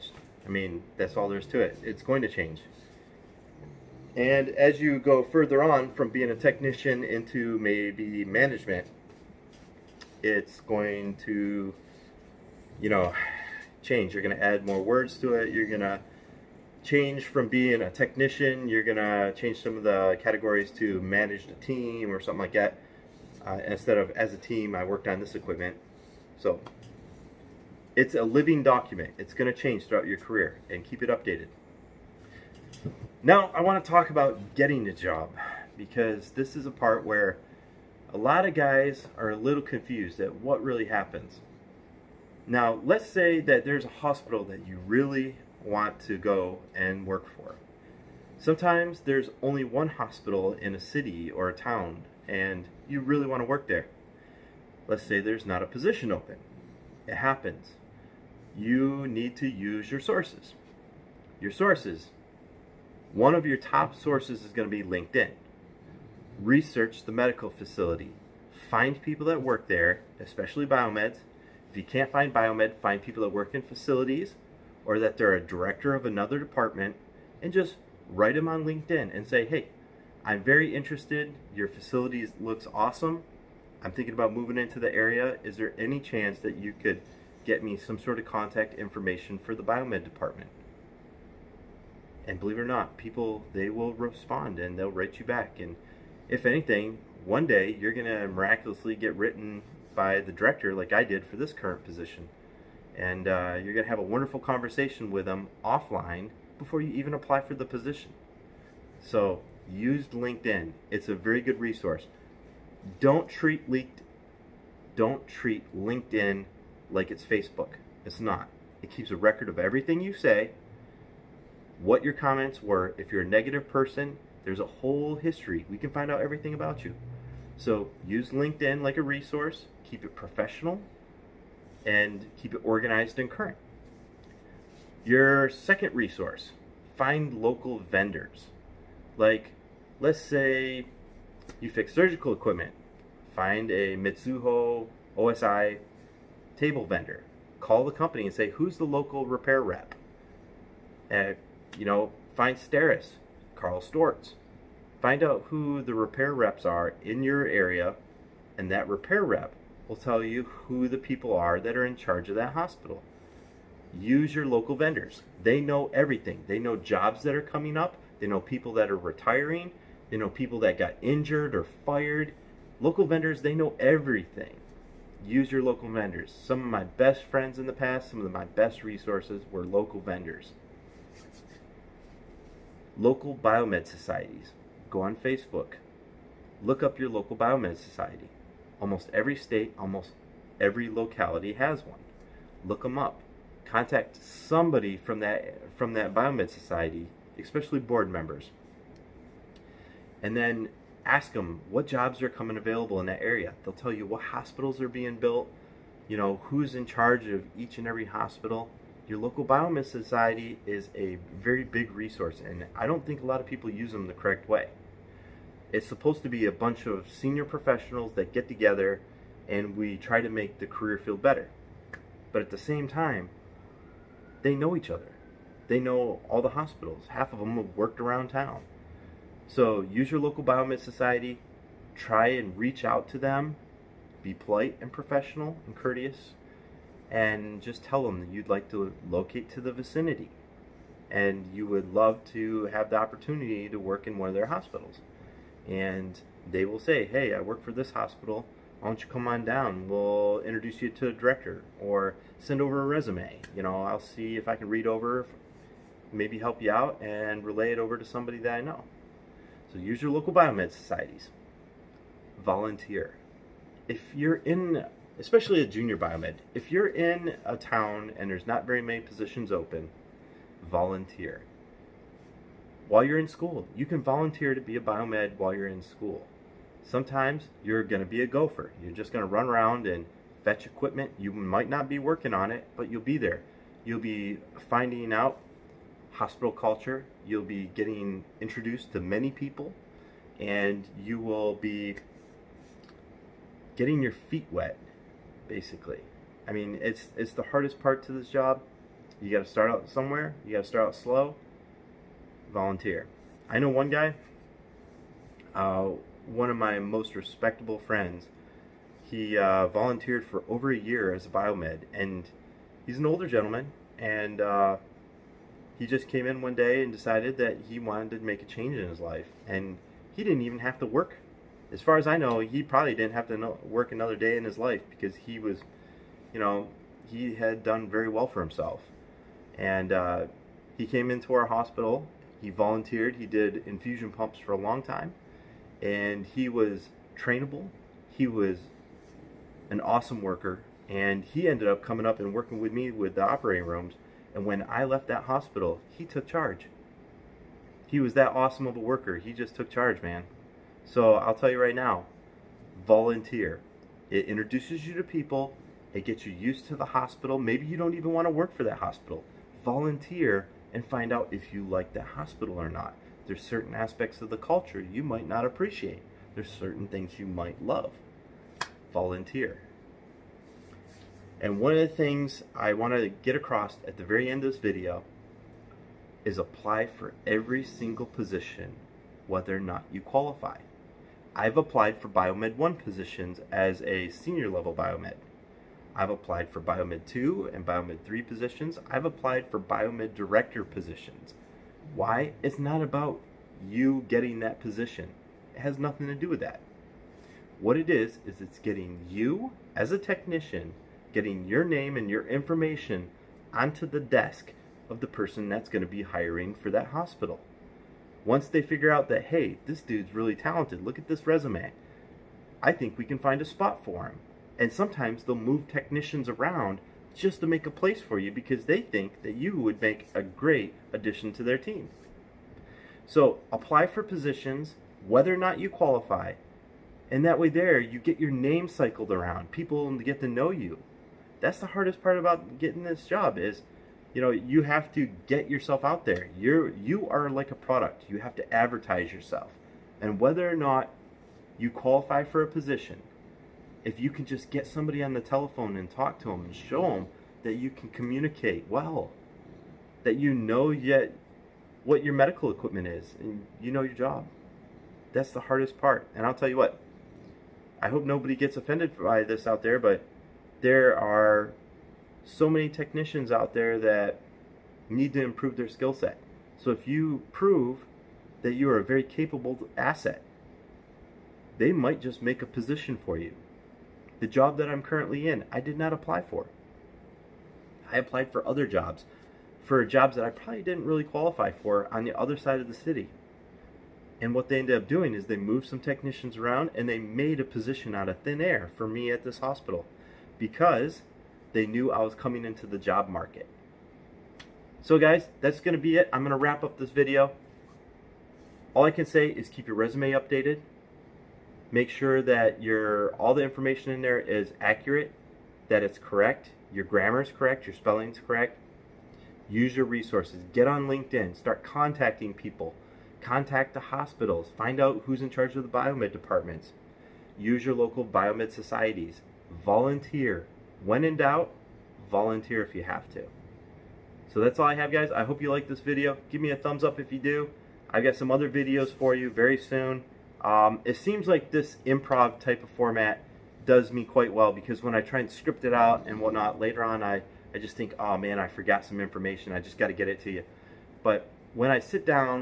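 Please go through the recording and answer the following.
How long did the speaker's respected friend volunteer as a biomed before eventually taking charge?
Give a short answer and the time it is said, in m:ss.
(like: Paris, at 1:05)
over a year, at 5:10.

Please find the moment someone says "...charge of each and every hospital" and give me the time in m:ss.
3:26.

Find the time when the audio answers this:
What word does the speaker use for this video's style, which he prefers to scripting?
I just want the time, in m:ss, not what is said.
8:51.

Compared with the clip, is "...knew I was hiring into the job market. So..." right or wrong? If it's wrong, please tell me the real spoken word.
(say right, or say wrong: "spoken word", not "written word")
wrong: "coming", not "hiring".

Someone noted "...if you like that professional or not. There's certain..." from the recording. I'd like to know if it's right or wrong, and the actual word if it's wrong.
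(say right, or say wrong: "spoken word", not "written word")
wrong: "hospital", not "professional".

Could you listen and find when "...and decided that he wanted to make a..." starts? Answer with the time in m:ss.
5:16.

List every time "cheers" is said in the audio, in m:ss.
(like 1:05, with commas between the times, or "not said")
not said.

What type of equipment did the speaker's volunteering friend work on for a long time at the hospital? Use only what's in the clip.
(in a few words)
infusion pumps.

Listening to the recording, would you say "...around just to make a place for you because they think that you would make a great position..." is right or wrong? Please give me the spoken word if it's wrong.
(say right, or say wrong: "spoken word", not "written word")
wrong: "addition", not "position".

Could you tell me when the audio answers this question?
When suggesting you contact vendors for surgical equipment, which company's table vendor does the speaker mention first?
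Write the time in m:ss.
2:23.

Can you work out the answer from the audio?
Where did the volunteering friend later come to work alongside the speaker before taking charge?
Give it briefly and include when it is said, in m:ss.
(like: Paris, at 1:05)
the operating rooms, at 5:43.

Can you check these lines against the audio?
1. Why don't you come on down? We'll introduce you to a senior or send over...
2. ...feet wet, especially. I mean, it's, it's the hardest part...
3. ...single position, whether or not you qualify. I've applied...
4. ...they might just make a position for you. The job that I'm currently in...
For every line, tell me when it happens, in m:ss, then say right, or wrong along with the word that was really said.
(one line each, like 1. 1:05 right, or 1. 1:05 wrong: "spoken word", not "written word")
1. 4:08 wrong: "director", not "senior"
2. 4:54 wrong: "basically", not "especially"
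3. 6:17 right
4. 7:51 right.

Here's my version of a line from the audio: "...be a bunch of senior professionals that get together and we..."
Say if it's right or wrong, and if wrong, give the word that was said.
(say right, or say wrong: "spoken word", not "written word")
right.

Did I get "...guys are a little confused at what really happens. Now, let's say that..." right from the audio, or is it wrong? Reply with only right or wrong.
right.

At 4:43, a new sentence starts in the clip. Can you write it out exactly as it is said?
You'll be finding out hospital culture.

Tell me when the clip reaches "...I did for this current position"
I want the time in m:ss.
1:40.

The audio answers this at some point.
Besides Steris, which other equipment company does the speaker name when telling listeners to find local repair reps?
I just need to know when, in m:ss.
2:33.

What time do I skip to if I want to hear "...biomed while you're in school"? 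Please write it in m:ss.
4:34.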